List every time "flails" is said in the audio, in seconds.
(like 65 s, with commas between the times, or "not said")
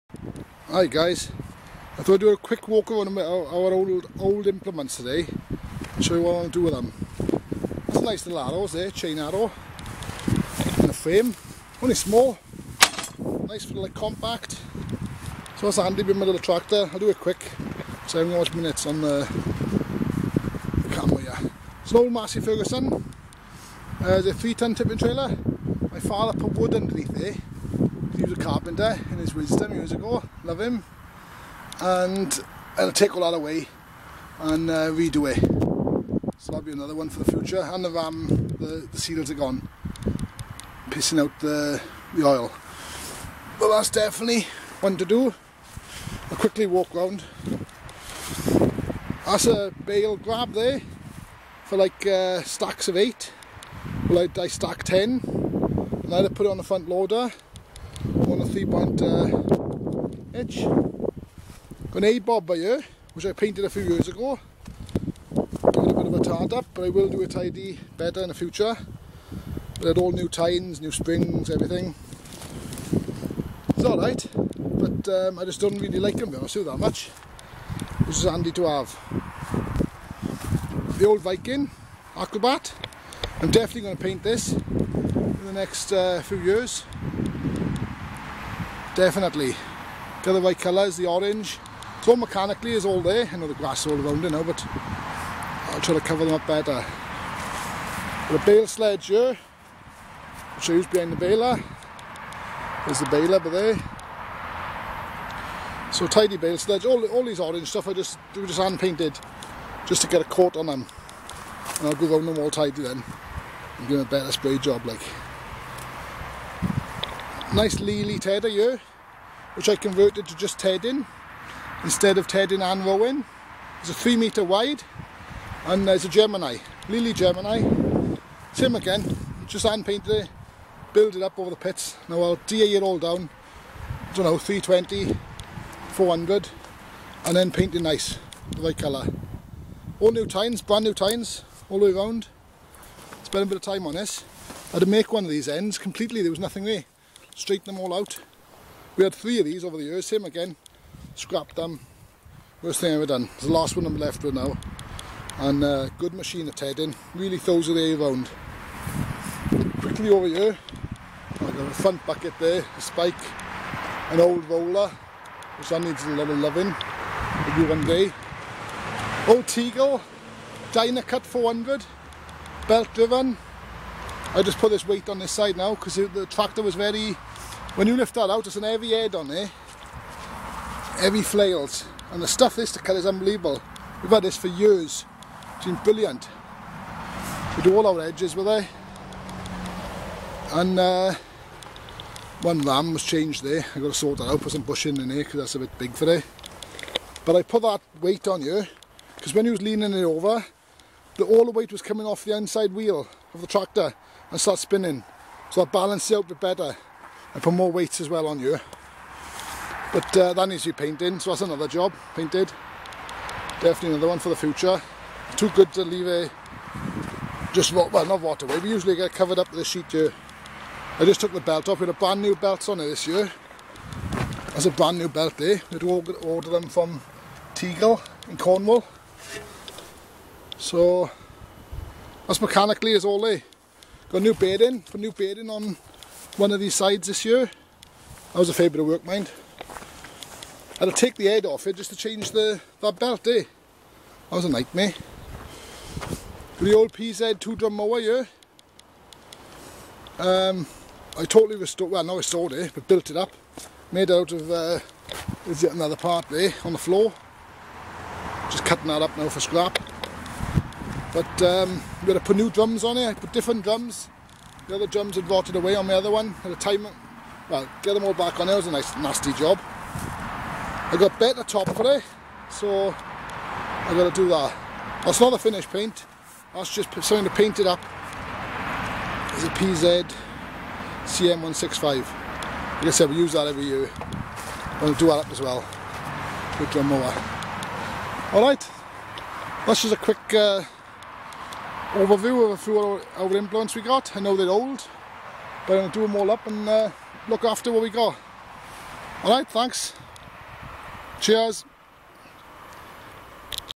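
181 s.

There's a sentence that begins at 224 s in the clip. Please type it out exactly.
That's a brand new belt there, eh?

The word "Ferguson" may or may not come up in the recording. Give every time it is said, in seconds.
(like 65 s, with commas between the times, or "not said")
22 s.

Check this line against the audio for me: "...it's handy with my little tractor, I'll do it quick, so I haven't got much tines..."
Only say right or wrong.
wrong.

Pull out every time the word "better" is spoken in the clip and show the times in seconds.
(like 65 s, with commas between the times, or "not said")
67 s, 96 s, 114 s, 206 s, 271 s.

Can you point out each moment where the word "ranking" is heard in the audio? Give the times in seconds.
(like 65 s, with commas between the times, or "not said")
not said.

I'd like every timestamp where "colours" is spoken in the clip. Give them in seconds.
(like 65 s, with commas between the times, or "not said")
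90 s, 138 s.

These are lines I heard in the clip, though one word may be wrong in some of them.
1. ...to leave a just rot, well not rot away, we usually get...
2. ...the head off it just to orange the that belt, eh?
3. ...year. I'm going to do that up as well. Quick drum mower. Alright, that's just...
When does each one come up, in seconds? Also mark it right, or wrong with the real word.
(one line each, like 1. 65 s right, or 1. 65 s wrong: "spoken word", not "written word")
1. 215 s right
2. 241 s wrong: "change", not "orange"
3. 283 s right.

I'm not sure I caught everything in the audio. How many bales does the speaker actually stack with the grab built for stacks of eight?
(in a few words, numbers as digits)
10.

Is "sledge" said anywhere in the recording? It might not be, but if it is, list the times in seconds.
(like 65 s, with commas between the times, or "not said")
98 s, 106 s.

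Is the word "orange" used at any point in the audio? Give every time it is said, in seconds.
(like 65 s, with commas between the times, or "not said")
91 s, 107 s.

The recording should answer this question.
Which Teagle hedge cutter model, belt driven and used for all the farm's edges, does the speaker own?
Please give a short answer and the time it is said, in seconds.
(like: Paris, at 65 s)
Dynacut 400, at 170 s.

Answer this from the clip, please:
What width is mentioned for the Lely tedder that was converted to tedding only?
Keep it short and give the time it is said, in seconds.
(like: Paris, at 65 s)
3 meters, at 123 s.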